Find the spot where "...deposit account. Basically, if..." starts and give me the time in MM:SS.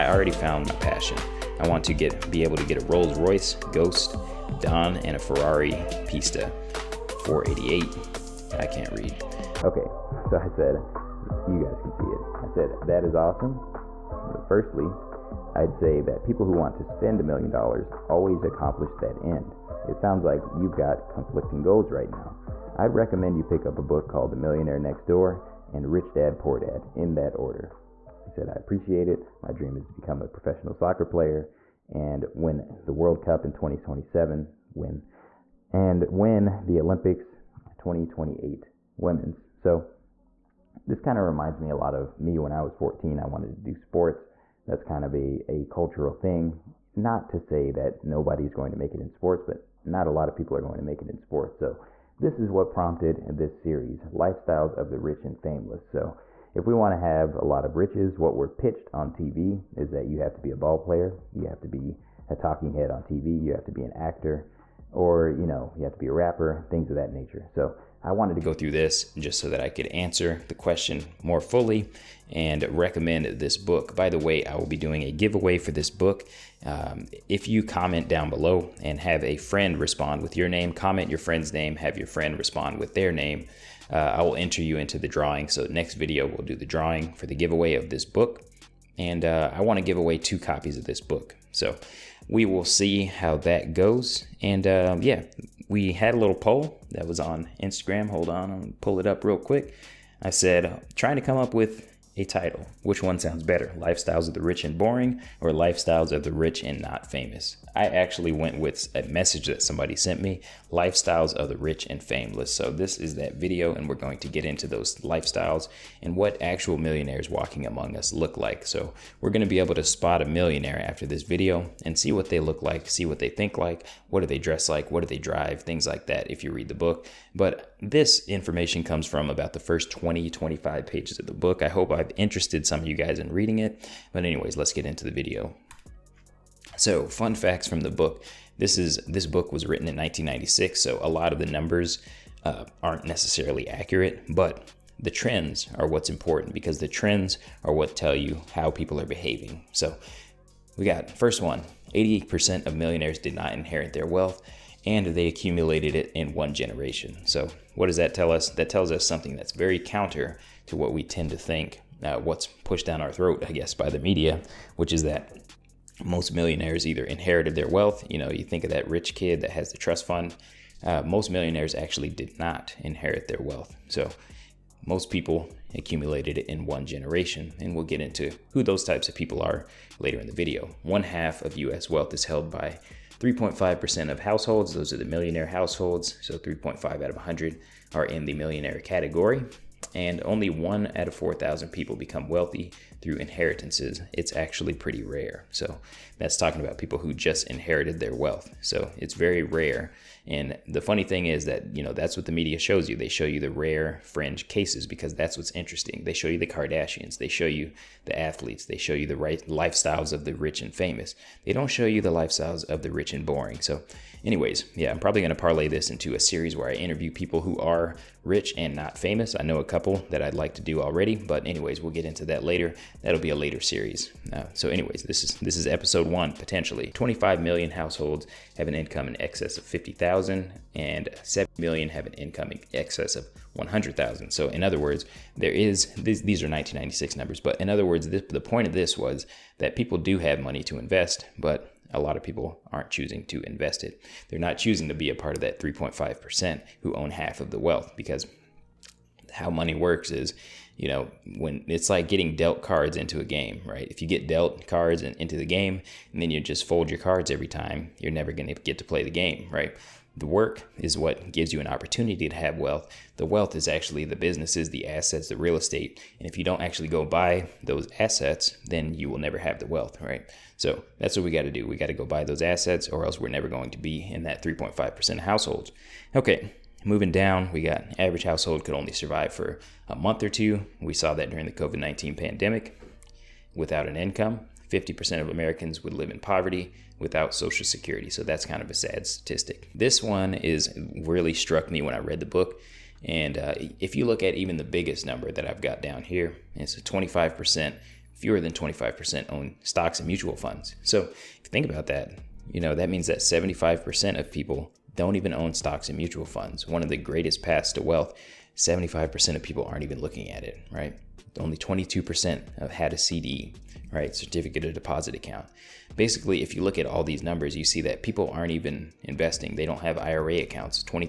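05:14.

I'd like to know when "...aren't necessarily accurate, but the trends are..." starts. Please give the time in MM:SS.
02:22.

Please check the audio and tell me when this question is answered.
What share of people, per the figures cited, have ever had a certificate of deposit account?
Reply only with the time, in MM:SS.
05:11.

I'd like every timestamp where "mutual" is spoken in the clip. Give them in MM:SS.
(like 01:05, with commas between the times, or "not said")
05:00, 05:05.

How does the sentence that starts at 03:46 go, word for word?
25 million households have an income in excess of 50,000, and 7 million have an income in excess of 100,000.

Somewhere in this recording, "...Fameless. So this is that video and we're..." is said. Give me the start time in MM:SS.
01:52.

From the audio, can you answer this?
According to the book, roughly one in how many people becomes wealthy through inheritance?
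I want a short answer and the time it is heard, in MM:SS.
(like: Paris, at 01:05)
4,000, at 03:11.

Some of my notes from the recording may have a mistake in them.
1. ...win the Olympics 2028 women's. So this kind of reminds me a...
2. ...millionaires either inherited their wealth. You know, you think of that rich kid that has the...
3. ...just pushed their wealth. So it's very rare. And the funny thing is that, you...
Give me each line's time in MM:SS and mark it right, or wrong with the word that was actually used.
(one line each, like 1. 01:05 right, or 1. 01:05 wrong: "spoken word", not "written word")
1. 00:36 right
2. 02:46 right
3. 03:17 wrong: "inherited", not "pushed".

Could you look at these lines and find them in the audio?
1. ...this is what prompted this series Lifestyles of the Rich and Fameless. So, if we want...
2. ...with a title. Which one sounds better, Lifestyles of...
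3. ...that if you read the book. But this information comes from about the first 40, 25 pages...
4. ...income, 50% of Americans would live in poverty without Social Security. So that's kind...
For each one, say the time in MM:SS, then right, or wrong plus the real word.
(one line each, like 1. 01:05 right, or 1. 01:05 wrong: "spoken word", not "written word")
1. 00:52 right
2. 01:41 right
3. 02:06 wrong: "20", not "40"
4. 04:43 right.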